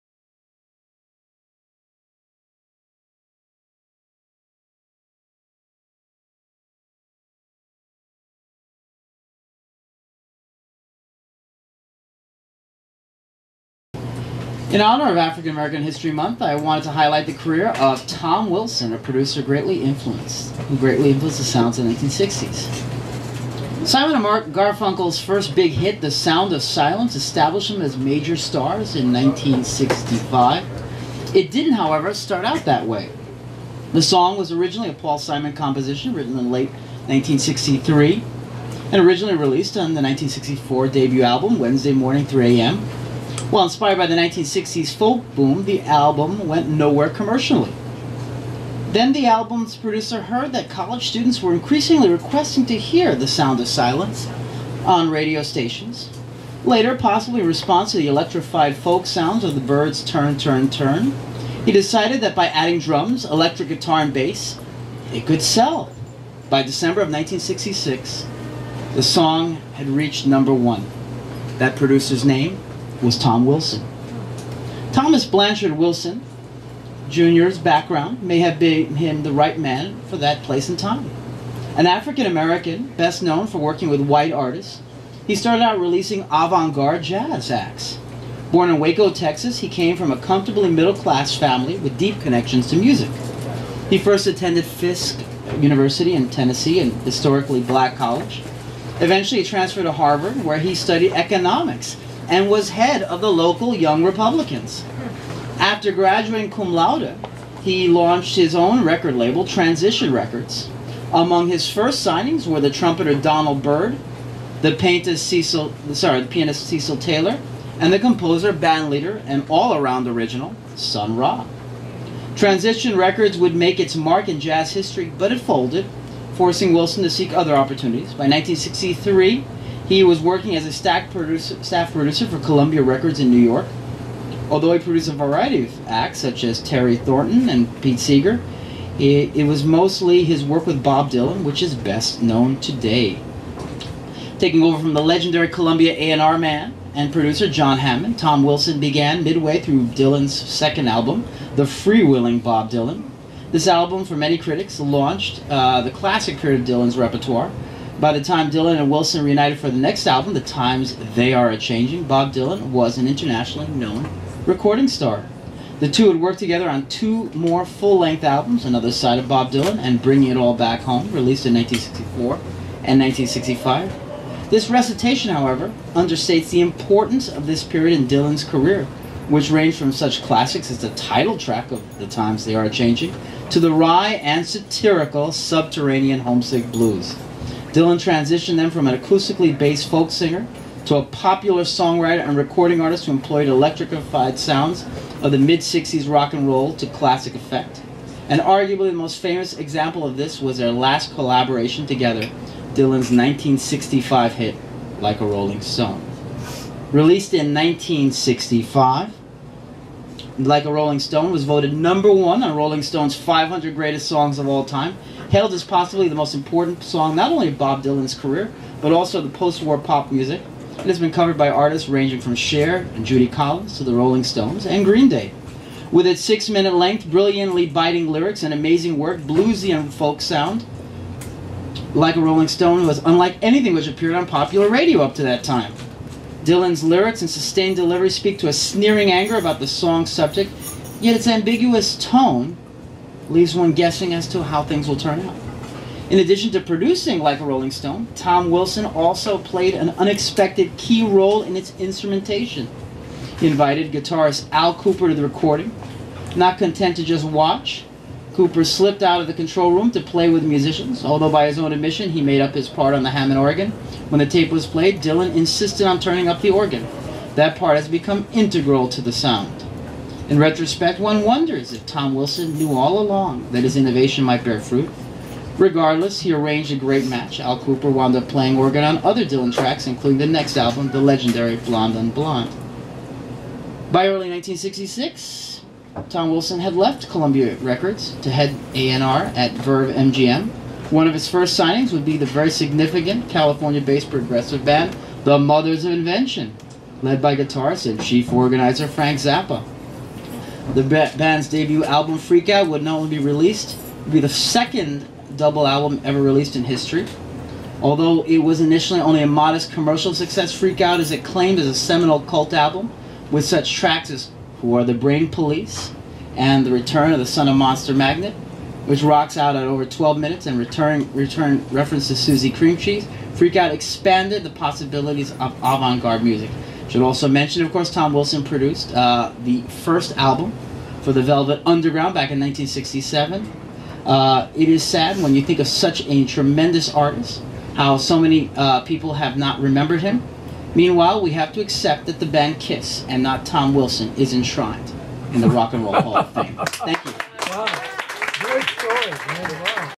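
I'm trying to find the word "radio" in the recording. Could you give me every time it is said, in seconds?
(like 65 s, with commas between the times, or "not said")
55 s, 234 s.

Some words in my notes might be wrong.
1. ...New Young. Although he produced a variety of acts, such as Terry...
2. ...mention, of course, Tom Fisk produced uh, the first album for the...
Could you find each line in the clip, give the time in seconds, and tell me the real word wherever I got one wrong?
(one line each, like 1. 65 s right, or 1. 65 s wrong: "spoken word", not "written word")
1. 133 s wrong: "York", not "Young"
2. 327 s wrong: "Wilson", not "Fisk".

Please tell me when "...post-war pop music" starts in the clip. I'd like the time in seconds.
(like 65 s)
219 s.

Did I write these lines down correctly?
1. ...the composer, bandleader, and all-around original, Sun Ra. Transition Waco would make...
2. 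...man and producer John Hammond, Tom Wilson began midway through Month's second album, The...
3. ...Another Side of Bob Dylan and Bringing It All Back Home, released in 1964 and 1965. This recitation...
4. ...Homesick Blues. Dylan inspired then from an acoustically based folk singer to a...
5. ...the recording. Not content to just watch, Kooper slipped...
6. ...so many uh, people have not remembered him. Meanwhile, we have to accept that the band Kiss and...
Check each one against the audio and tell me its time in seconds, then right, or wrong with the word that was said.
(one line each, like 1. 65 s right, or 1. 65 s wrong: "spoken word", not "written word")
1. 117 s wrong: "Records", not "Waco"
2. 146 s wrong: "Dylan", not "Month"
3. 168 s right
4. 186 s wrong: "transitioned", not "inspired"
5. 255 s right
6. 337 s right.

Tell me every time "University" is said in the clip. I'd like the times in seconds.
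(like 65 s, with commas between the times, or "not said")
95 s.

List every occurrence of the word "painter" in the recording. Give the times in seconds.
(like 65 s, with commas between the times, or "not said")
114 s.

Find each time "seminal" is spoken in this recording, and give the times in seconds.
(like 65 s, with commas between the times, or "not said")
311 s.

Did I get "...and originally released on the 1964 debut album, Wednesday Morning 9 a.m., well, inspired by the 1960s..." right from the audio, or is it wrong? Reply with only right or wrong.
wrong.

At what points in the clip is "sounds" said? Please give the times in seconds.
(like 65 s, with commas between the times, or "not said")
21 s, 26 s, 53 s, 59 s, 194 s, 230 s, 269 s.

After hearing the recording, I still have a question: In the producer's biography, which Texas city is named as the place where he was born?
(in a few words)
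Waco.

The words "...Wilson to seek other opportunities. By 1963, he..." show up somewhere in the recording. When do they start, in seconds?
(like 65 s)
126 s.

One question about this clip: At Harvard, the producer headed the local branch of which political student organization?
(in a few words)
Young Republicans.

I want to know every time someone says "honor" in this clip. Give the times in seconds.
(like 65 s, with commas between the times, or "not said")
14 s.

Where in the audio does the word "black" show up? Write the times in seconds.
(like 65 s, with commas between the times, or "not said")
97 s.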